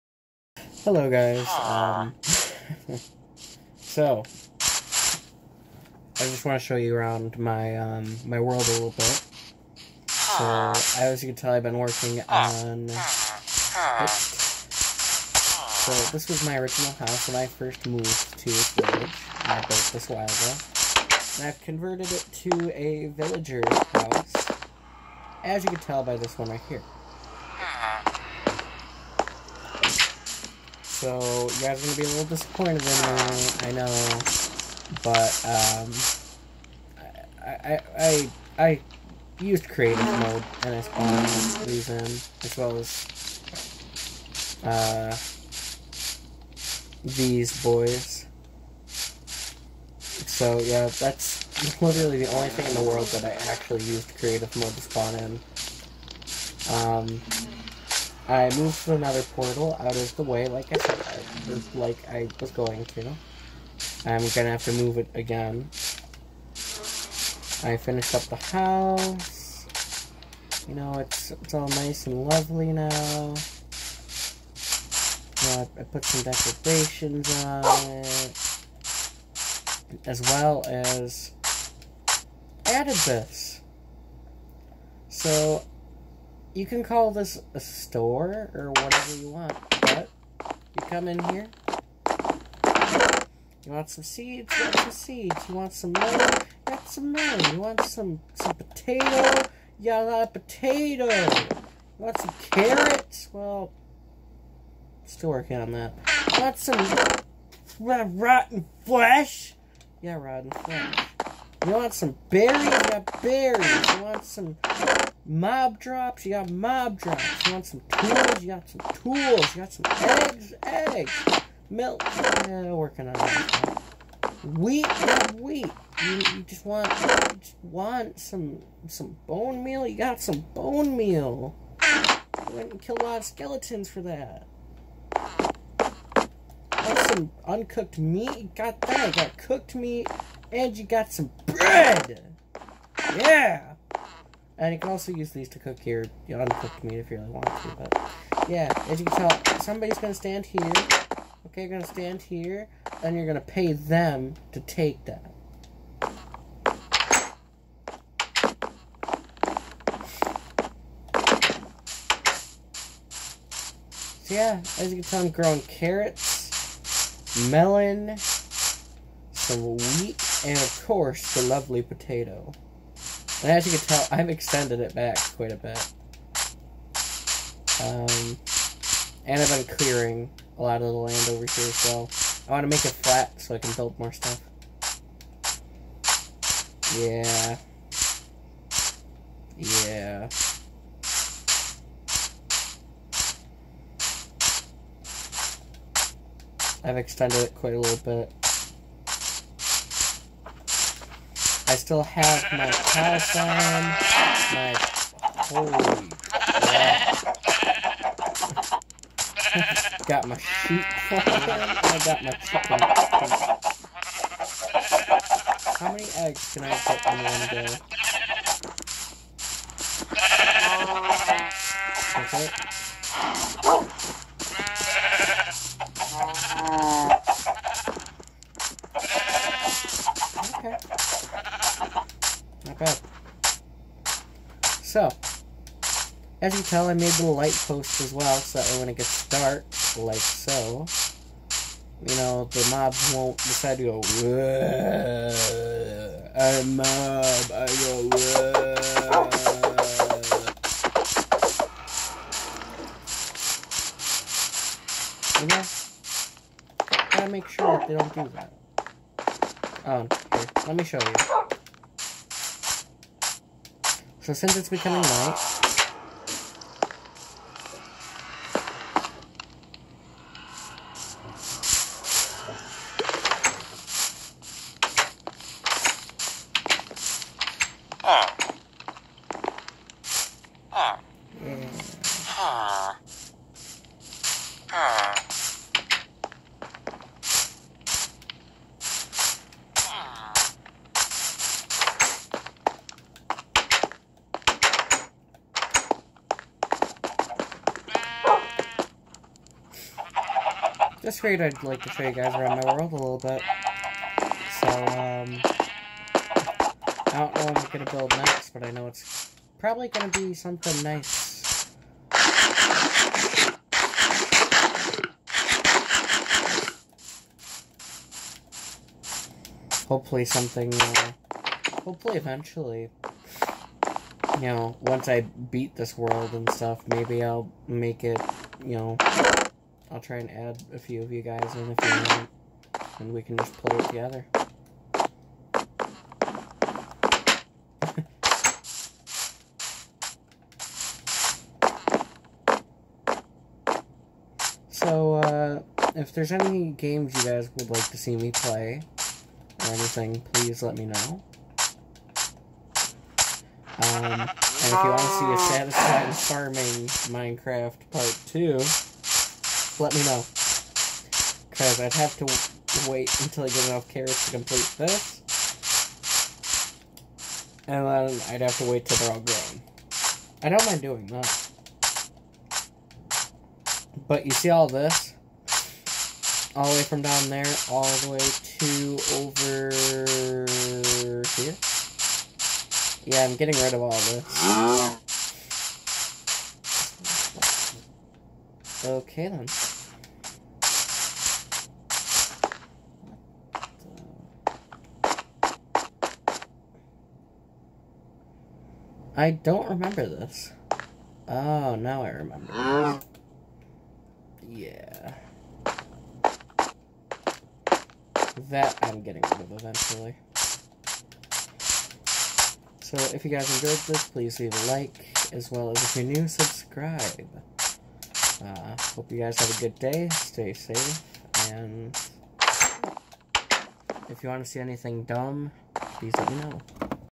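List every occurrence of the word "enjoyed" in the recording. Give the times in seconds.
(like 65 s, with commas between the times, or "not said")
413 s.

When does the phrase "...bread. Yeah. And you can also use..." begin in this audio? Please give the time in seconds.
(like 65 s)
141 s.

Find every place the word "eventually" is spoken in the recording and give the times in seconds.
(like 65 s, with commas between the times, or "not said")
322 s, 409 s.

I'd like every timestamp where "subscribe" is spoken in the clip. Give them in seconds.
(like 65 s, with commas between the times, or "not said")
416 s.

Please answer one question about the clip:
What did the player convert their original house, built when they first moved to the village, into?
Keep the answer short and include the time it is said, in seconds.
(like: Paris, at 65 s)
villager's house, at 23 s.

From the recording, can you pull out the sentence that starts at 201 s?
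I still have my house on.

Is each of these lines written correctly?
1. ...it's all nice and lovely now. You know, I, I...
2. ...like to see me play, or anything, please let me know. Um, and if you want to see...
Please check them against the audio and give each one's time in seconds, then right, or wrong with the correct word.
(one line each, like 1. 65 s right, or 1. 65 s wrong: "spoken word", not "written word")
1. 71 s right
2. 347 s right.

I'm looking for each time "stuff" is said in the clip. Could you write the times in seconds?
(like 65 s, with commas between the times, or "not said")
184 s, 326 s.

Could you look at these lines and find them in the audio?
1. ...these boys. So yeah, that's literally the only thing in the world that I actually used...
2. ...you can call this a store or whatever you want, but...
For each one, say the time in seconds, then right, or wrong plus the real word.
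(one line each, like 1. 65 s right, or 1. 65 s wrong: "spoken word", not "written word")
1. 47 s right
2. 86 s right.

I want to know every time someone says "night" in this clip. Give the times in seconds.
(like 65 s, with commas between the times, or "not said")
265 s.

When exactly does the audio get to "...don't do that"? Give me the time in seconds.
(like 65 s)
257 s.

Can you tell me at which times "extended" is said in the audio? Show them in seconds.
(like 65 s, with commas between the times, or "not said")
174 s, 196 s.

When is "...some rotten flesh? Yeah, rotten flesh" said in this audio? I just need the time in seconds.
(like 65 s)
106 s.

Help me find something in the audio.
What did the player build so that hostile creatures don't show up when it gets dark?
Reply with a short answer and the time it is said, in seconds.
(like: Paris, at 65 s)
light post, at 237 s.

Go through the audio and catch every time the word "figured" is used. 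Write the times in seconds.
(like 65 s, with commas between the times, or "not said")
301 s.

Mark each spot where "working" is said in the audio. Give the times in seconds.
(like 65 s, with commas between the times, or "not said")
11 s, 105 s, 122 s.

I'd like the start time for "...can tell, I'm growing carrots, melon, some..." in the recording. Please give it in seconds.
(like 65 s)
165 s.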